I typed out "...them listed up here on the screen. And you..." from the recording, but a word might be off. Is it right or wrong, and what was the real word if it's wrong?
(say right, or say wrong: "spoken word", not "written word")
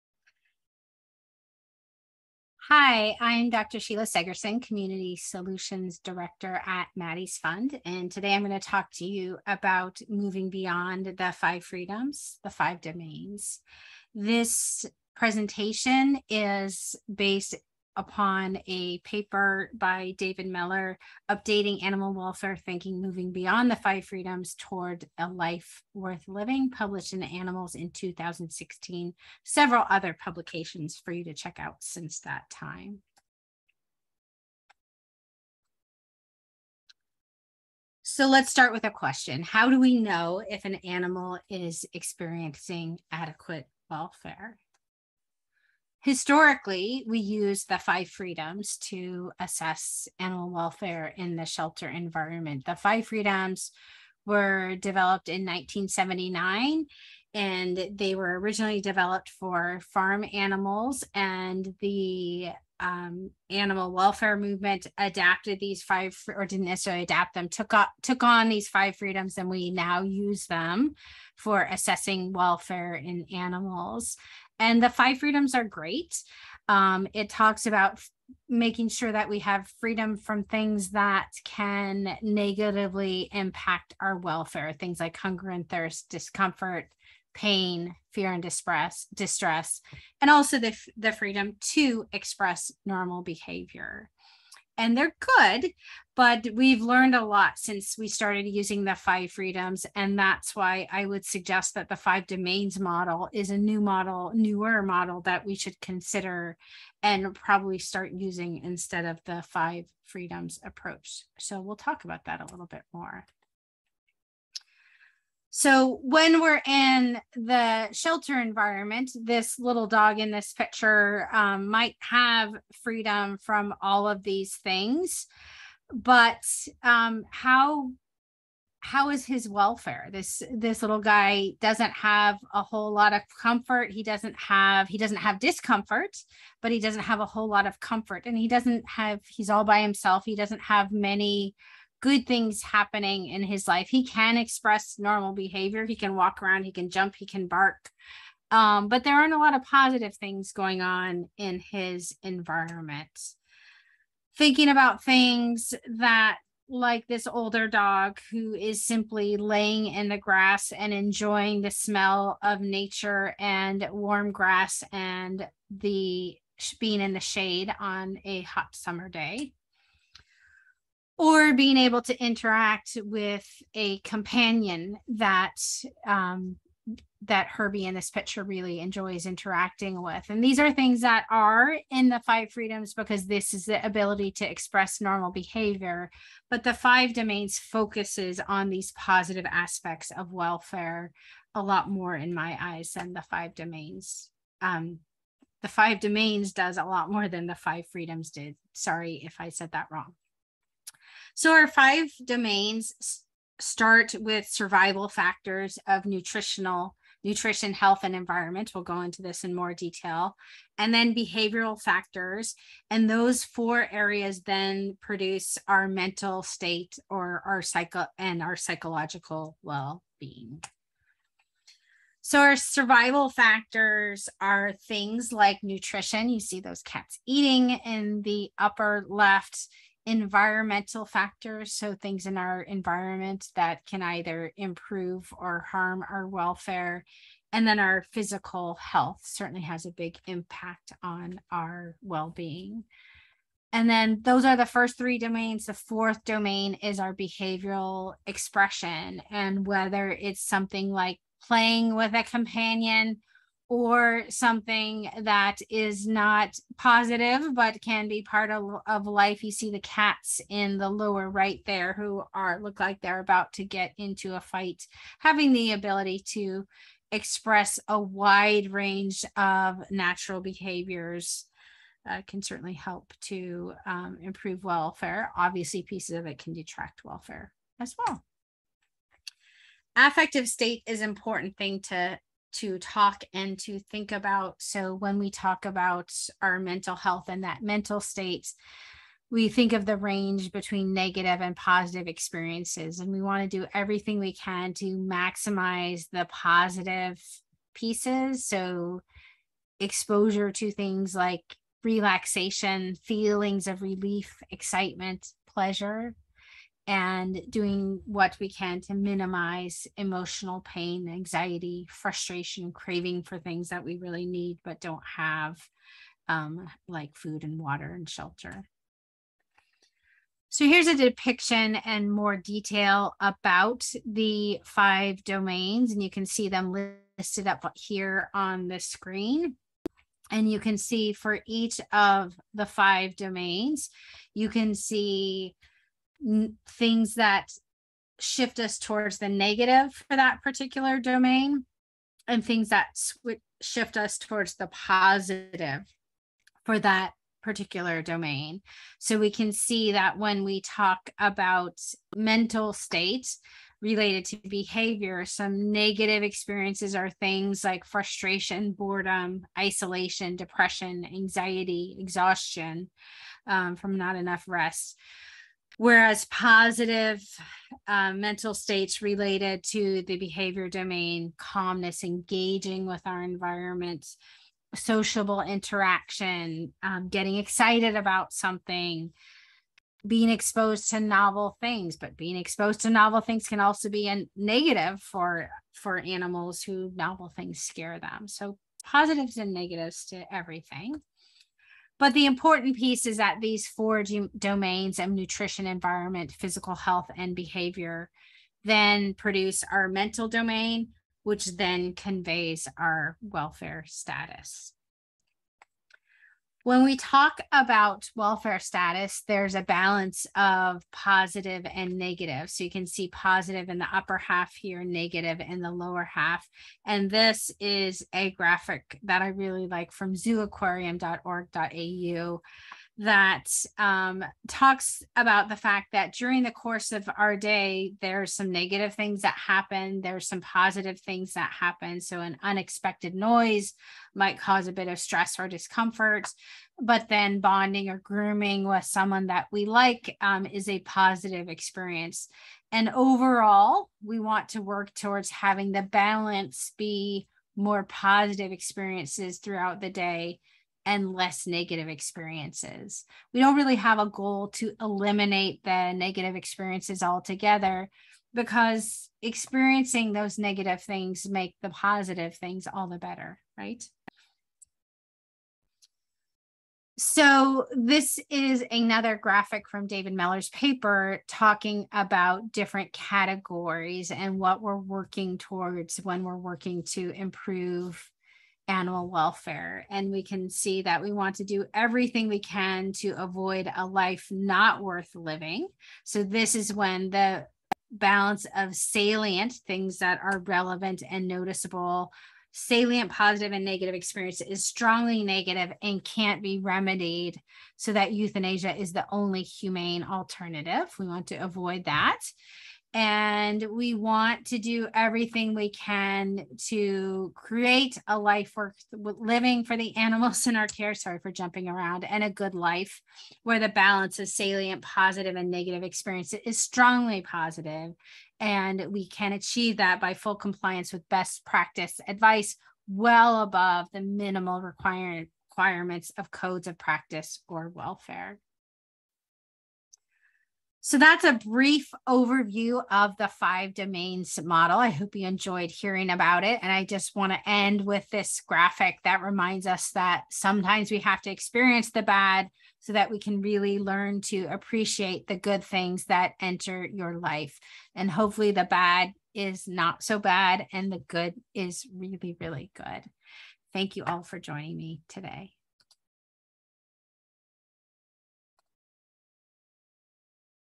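right.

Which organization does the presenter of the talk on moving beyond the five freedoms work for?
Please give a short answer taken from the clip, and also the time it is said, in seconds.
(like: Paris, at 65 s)
Maddie's Fund, at 6 s.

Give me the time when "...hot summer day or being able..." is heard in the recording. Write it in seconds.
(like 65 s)
168 s.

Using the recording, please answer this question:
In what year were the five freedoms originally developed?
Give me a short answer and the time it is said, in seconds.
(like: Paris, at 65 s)
1979, at 55 s.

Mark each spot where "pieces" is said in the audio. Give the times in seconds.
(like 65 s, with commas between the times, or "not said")
275 s, 297 s, 392 s.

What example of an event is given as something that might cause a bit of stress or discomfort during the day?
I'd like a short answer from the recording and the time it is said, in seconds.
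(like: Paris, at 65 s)
an unexpected noise, at 432 s.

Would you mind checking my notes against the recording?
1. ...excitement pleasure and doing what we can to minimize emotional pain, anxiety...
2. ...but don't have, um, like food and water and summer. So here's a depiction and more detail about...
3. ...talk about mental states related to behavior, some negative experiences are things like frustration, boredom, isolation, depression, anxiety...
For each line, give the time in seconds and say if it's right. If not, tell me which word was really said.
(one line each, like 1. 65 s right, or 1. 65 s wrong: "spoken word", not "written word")
1. 304 s right
2. 314 s wrong: "shelter", not "summer"
3. 350 s right.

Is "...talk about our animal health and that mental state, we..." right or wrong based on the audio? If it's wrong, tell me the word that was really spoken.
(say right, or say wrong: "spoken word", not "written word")
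wrong: "mental", not "animal".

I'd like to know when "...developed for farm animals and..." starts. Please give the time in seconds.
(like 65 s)
58 s.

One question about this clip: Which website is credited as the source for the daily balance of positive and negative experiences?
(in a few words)
zooaquarium.org.au.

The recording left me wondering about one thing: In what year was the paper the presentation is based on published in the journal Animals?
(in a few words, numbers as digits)
2016.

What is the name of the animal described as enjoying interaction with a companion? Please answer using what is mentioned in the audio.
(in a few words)
Herbie.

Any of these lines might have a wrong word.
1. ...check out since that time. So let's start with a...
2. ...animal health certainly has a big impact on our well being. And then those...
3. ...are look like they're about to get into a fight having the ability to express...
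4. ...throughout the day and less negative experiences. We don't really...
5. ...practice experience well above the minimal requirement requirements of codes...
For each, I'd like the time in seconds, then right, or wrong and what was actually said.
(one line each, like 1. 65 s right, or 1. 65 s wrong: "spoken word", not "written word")
1. 31 s right
2. 238 s wrong: "physical", not "animal"
3. 262 s right
4. 449 s right
5. 521 s wrong: "advice", not "experience".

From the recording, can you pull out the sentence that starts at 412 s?
So you can see positive in the upper half here, negative in the lower half.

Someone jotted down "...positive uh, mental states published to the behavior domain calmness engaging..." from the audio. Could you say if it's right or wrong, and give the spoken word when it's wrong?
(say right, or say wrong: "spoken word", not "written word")
wrong: "related", not "published".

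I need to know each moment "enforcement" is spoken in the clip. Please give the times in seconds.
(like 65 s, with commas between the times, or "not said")
not said.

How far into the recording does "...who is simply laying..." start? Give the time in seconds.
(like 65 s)
158 s.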